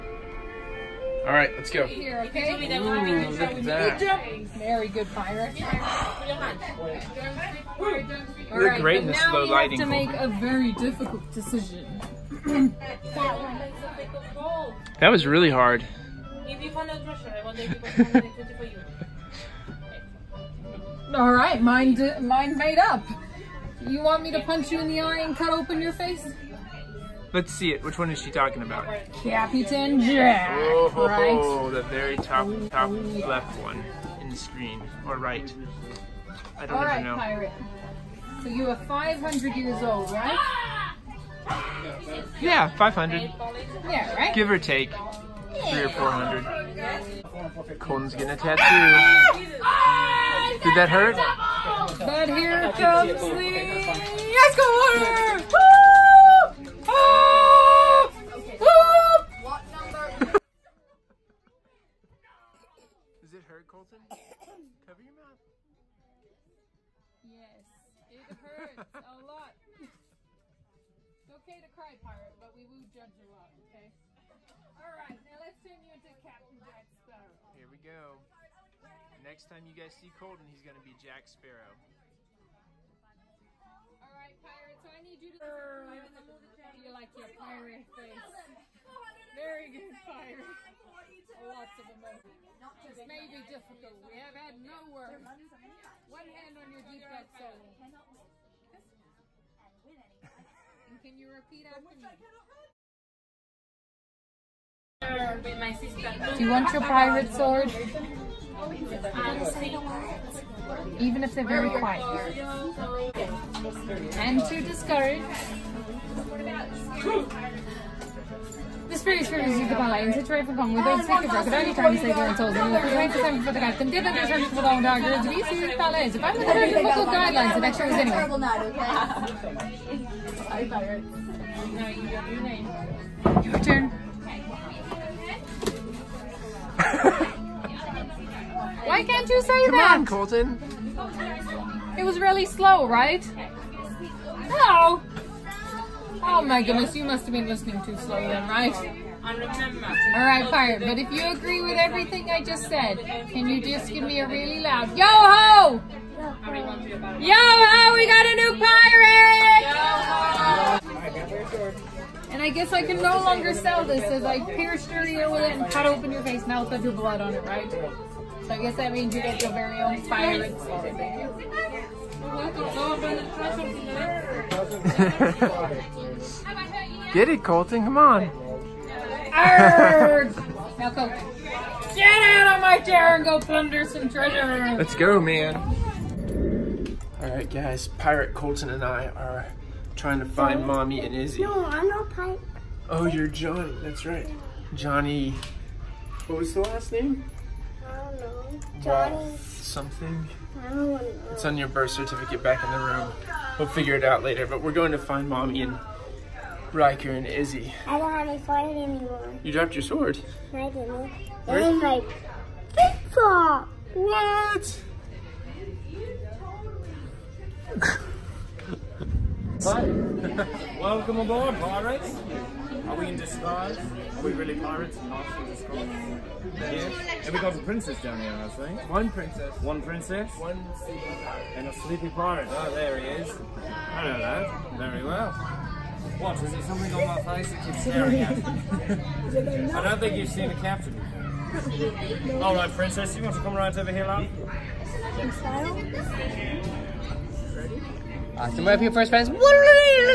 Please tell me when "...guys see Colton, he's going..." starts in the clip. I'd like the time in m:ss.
1:19.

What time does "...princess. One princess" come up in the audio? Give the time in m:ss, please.
3:49.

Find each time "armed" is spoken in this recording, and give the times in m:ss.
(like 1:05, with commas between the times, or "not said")
not said.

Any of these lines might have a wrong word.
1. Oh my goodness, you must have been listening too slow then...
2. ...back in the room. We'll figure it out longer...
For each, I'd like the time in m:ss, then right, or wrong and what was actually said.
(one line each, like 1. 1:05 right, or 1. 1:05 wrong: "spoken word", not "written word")
1. 2:26 right
2. 3:22 wrong: "later", not "longer".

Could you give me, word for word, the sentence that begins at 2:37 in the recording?
Yo-ho, we got a new pirate!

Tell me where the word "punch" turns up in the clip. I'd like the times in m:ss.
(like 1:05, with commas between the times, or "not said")
0:24.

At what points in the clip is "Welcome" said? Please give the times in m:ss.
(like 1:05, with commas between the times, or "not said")
3:40.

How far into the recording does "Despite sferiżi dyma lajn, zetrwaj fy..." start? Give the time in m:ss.
1:58.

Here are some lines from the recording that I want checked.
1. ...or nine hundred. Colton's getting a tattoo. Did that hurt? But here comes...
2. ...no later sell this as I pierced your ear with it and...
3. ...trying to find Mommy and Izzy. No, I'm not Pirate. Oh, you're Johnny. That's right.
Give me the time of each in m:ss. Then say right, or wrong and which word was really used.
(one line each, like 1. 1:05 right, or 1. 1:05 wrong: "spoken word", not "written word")
1. 0:45 wrong: "four", not "nine"
2. 2:42 wrong: "longer", not "later"
3. 3:09 right.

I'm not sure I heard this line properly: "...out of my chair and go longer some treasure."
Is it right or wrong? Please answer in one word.
wrong.